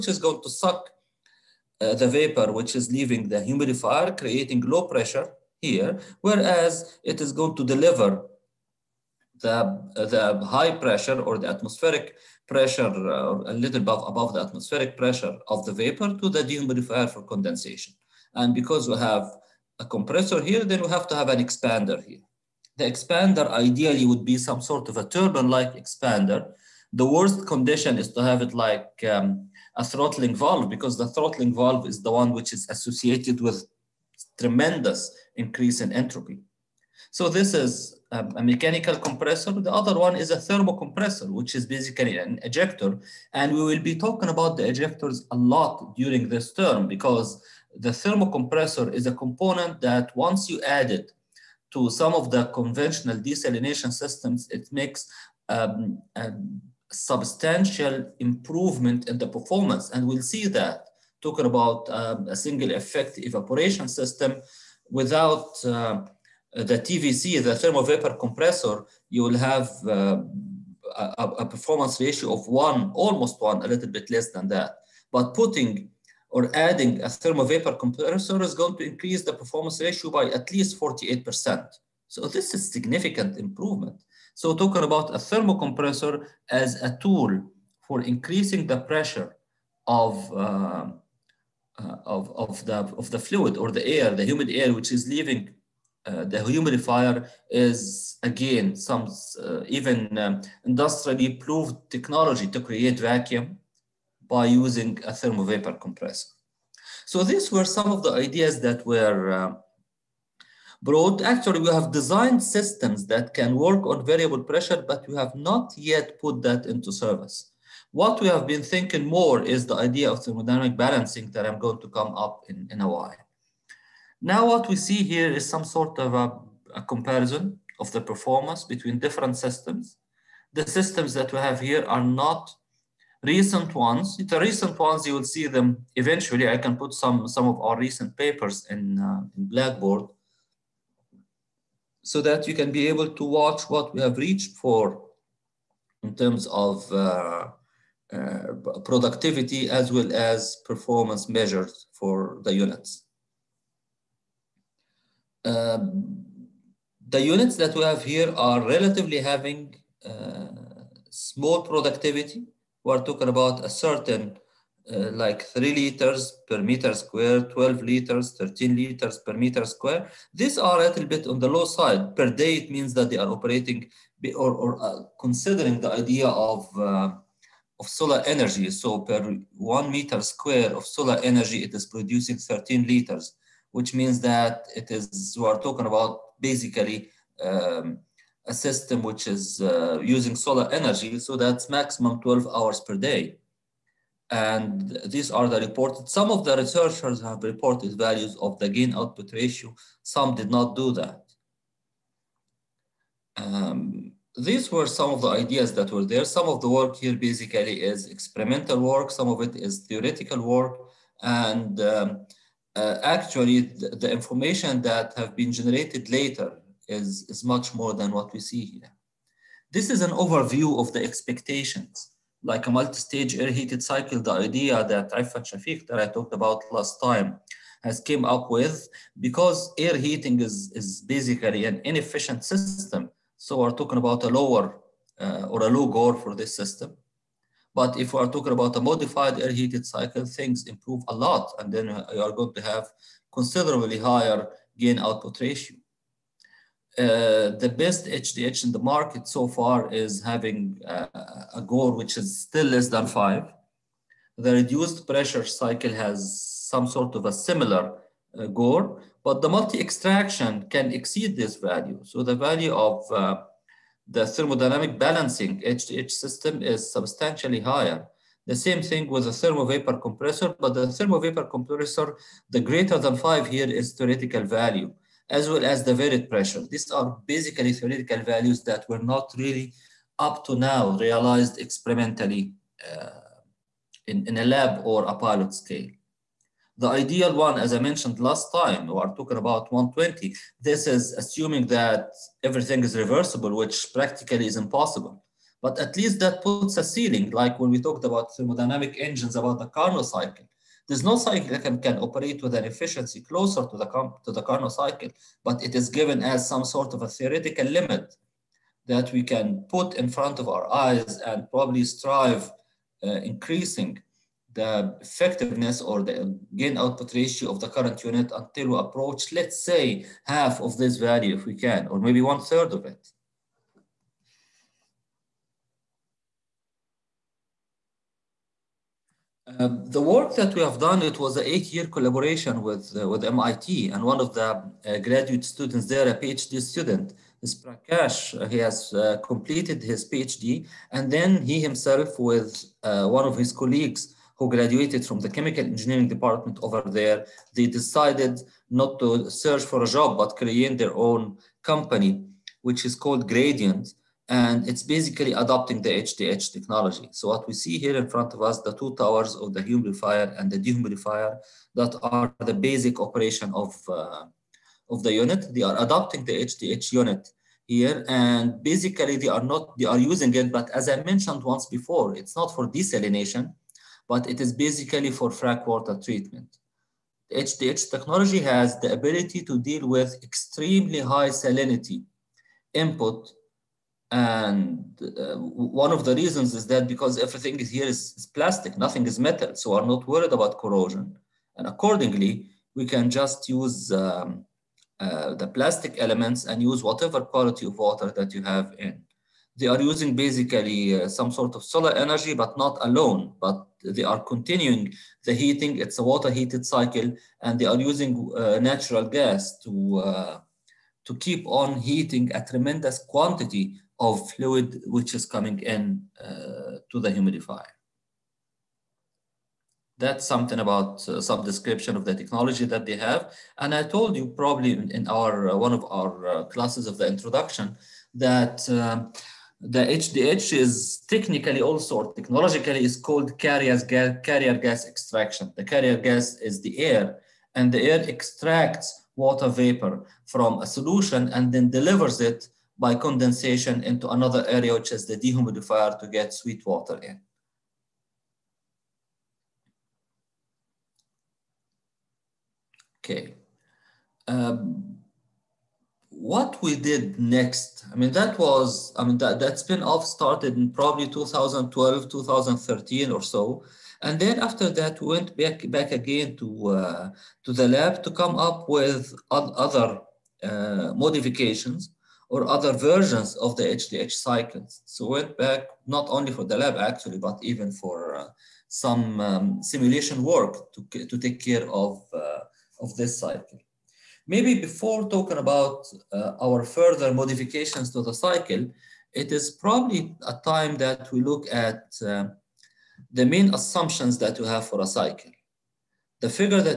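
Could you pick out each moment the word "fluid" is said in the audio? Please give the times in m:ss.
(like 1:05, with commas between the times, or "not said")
1:33, 6:54.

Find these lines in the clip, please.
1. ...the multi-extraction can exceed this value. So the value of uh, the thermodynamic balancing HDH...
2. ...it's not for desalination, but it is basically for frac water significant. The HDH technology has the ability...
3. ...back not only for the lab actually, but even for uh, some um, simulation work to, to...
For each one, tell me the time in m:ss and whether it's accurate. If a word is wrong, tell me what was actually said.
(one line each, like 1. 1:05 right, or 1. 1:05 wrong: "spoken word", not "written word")
1. 4:19 right
2. 6:12 wrong: "treatment", not "significant"
3. 7:55 right.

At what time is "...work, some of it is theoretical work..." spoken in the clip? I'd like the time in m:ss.
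3:28.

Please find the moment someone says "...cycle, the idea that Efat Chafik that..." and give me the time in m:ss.
3:43.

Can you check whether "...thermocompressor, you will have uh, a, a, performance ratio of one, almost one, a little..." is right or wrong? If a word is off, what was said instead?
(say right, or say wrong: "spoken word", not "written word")
wrong: "compressor", not "thermocompressor".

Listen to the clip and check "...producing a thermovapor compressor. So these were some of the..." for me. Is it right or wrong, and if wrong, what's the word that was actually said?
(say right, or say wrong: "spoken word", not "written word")
wrong: "using", not "producing".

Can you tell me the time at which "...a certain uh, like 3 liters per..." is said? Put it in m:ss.
2:43.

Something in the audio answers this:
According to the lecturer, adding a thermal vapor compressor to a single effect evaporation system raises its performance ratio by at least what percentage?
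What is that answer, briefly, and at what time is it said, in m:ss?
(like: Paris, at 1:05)
48%, at 1:20.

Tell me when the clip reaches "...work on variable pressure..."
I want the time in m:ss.
1:53.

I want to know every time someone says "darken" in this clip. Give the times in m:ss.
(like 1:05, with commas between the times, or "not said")
not said.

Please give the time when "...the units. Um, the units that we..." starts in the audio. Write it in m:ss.
2:32.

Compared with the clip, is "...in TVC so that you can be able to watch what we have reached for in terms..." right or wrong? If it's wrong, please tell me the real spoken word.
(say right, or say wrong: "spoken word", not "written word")
wrong: "Blackboard", not "TVC".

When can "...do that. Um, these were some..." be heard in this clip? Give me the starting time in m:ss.
3:20.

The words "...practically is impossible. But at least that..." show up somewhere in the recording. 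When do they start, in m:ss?
4:53.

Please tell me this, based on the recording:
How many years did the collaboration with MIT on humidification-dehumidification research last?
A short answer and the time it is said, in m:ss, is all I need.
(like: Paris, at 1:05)
8 years, at 5:31.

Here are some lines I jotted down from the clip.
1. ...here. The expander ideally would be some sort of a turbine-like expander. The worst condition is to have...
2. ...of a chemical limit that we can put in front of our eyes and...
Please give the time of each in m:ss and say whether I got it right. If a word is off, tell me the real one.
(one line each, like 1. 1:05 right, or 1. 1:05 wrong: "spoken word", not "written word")
1. 0:22 right
2. 5:06 wrong: "theoretical", not "chemical".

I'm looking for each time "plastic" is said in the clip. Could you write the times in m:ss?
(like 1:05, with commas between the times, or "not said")
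6:28, 6:35.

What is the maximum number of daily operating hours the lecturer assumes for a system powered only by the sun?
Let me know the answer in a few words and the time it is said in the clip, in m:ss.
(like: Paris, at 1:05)
12 hours, at 3:12.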